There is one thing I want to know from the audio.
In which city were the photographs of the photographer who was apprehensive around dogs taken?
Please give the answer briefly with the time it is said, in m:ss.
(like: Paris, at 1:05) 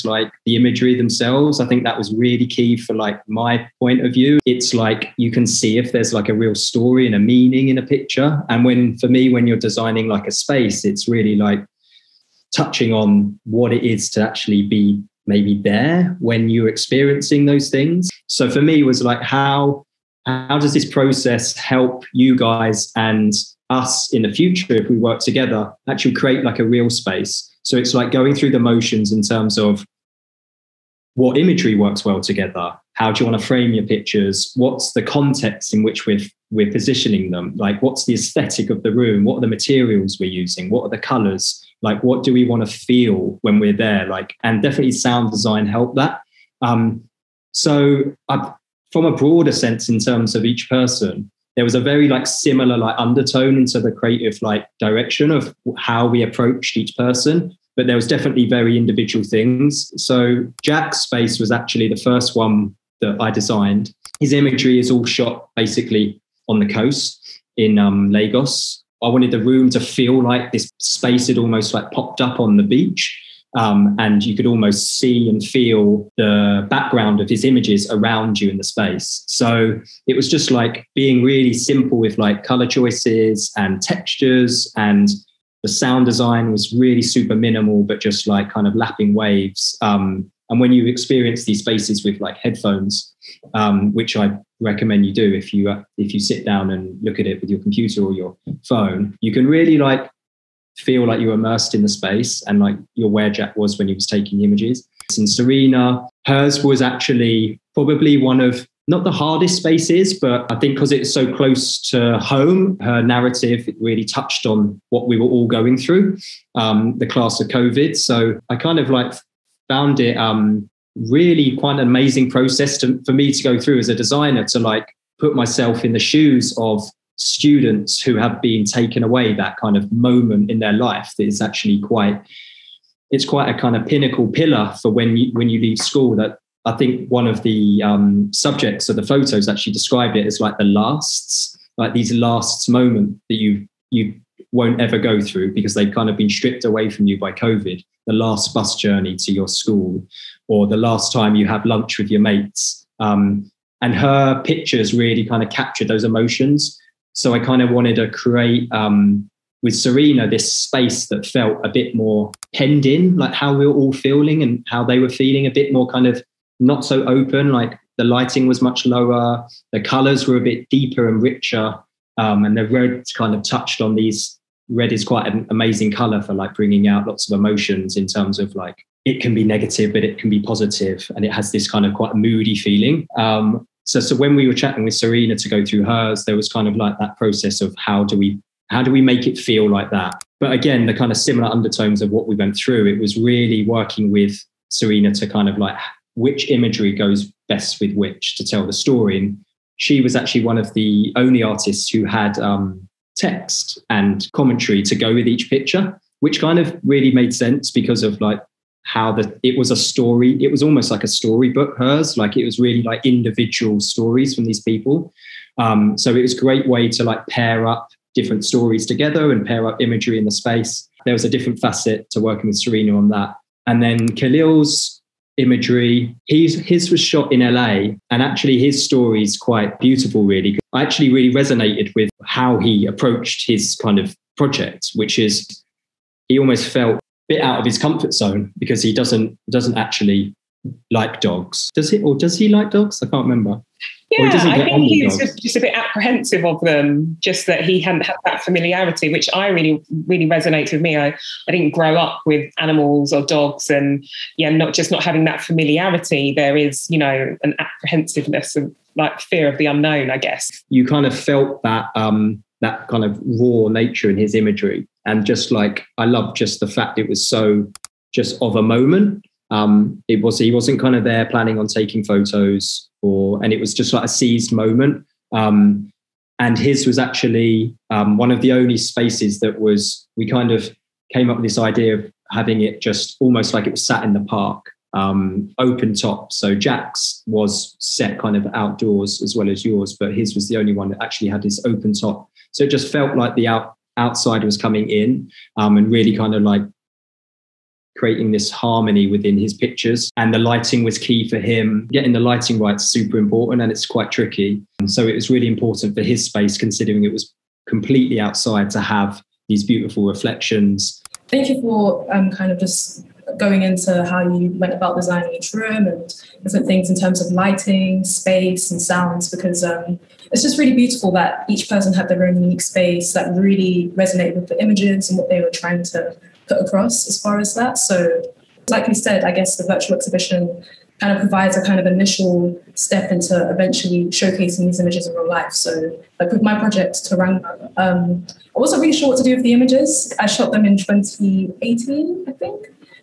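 LA, at 3:47.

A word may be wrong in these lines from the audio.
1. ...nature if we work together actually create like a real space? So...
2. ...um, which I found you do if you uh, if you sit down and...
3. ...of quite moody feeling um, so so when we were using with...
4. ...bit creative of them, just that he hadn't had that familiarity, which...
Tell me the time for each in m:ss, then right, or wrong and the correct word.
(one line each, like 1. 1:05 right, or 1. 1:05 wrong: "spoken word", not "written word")
1. 0:24 wrong: "future", not "nature"
2. 1:33 wrong: "recommend", not "found"
3. 3:01 wrong: "chatting", not "using"
4. 4:05 wrong: "apprehensive", not "creative".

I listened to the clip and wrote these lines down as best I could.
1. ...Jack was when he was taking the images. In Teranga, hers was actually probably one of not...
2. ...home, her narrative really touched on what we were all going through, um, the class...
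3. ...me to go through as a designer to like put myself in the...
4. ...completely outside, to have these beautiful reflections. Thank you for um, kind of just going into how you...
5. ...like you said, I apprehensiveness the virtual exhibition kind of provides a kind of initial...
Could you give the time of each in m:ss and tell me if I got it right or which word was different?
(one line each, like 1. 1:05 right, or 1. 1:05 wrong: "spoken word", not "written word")
1. 1:43 wrong: "Serena", not "Teranga"
2. 1:52 right
3. 2:03 right
4. 5:07 right
5. 5:28 wrong: "guess", not "apprehensiveness".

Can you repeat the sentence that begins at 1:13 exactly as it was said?
Um, and you could almost see and feel the background of his images around you in the space.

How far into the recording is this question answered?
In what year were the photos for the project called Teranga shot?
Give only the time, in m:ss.
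5:40.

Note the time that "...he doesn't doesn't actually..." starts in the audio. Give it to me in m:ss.
3:58.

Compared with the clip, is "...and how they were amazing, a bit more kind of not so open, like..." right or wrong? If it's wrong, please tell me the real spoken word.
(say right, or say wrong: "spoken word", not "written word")
wrong: "feeling", not "amazing".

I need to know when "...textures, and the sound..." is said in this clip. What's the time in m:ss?
1:23.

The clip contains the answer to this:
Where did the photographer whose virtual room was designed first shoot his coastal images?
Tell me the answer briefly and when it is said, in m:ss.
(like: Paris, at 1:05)
Lagos, at 1:08.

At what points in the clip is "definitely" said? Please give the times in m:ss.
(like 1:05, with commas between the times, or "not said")
0:44, 0:58.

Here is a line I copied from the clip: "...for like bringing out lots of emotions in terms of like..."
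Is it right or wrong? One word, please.
right.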